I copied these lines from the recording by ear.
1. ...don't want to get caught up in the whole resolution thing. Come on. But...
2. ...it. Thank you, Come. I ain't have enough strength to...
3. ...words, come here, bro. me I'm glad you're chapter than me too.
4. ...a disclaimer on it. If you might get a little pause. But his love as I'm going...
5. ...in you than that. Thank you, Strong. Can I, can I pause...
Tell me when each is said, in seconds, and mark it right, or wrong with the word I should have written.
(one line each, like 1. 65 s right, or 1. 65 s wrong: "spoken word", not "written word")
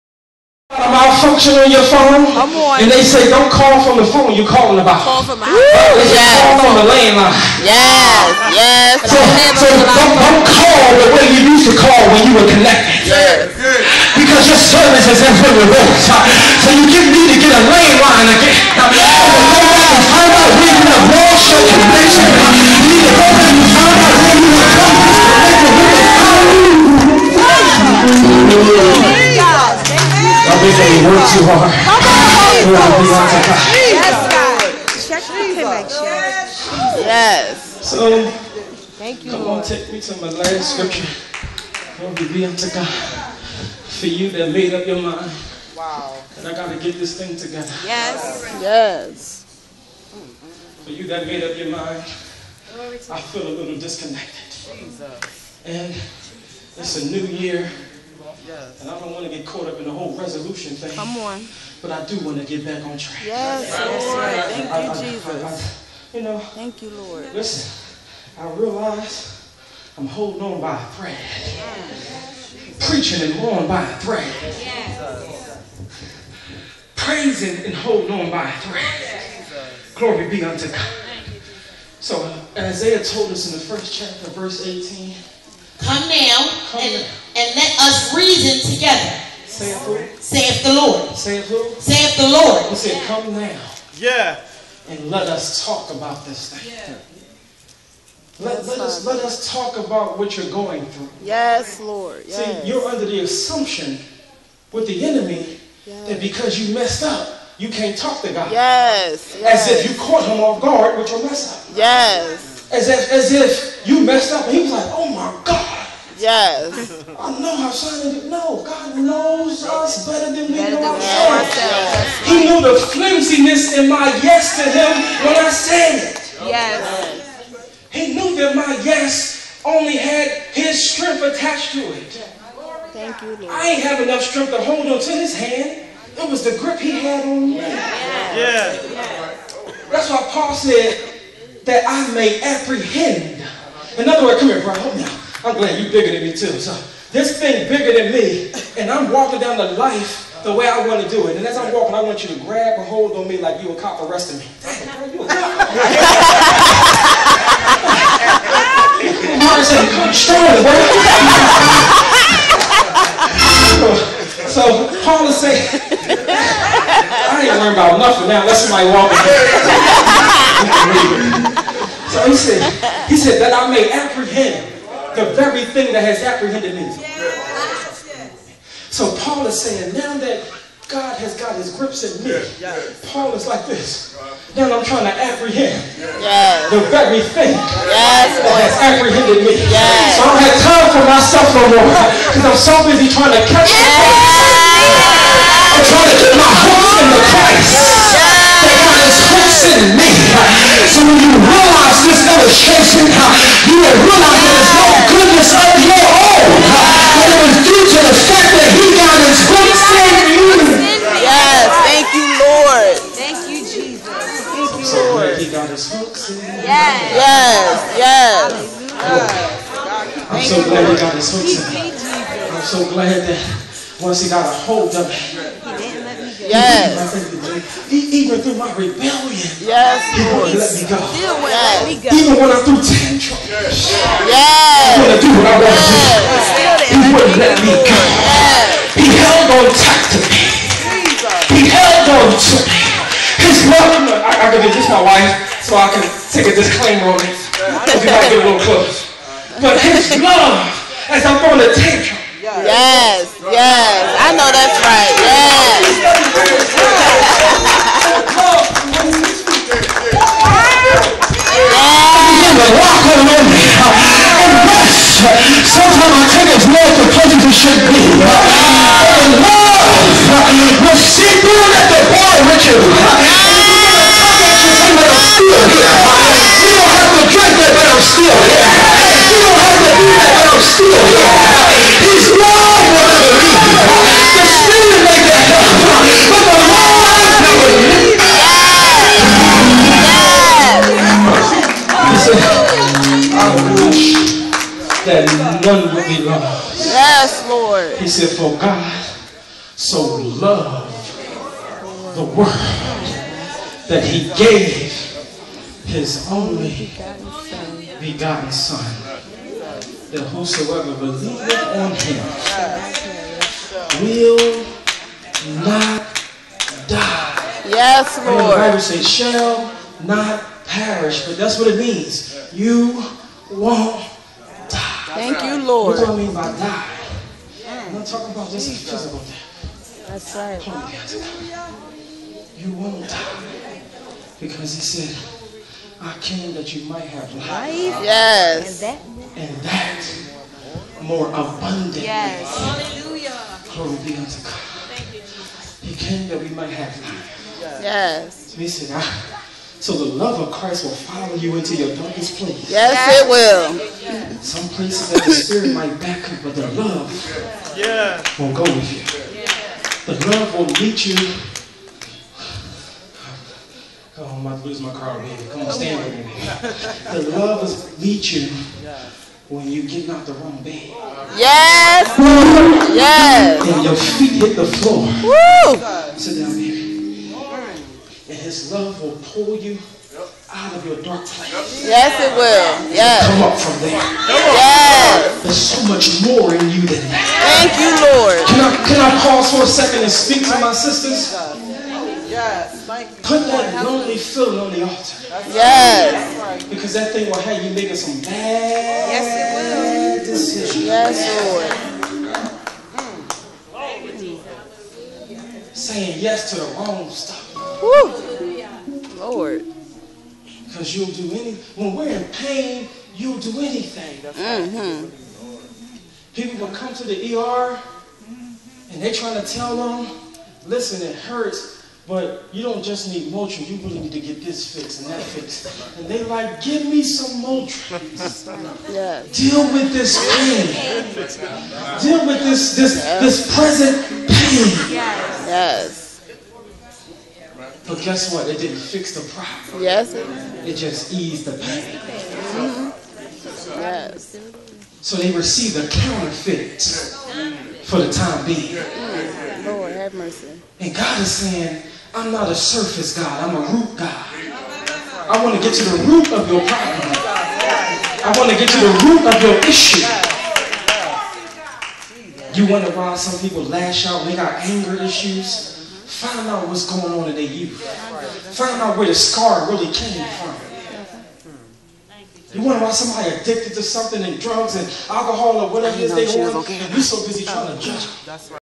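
1. 58 s right
2. 131 s wrong: "Lord", not "Come"
3. 144 s wrong: "bigger", not "chapter"
4. 246 s wrong: "close", not "pause"
5. 386 s wrong: "Lord", not "Strong".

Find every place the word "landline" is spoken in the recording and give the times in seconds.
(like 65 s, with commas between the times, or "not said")
6 s, 17 s.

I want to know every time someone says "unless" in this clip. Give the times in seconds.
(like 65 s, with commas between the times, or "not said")
168 s.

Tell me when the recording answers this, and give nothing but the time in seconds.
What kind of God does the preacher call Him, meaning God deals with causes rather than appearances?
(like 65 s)
453 s.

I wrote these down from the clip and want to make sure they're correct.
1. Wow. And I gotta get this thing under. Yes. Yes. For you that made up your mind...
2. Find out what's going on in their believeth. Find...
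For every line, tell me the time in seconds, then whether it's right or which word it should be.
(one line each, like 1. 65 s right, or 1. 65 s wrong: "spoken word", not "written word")
1. 45 s wrong: "together", not "under"
2. 466 s wrong: "youth", not "believeth".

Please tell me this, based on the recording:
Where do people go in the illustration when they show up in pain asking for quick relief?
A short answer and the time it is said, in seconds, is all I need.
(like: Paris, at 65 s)
The ER, at 417 s.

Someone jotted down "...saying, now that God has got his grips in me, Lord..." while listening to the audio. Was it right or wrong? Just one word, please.
wrong.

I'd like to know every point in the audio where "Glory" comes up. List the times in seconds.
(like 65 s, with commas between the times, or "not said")
41 s, 79 s, 343 s.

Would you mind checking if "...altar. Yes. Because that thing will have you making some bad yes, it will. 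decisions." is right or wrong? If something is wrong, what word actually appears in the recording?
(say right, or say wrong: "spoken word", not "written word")
right.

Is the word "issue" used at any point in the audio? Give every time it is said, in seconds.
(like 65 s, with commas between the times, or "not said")
459 s, 465 s.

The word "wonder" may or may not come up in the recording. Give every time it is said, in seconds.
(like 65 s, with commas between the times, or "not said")
462 s, 472 s.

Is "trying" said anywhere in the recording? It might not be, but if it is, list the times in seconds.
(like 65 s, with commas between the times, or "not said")
184 s, 193 s, 419 s, 477 s.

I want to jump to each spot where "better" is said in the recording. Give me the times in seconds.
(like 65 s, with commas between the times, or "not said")
120 s.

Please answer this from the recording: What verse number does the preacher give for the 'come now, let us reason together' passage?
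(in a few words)
Verse 18.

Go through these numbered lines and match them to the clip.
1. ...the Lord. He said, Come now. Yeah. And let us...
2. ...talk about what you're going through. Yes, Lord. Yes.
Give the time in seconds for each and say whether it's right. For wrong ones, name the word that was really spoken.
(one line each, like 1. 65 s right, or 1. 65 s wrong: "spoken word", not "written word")
1. 92 s right
2. 99 s right.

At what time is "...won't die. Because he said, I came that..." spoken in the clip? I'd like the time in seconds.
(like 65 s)
332 s.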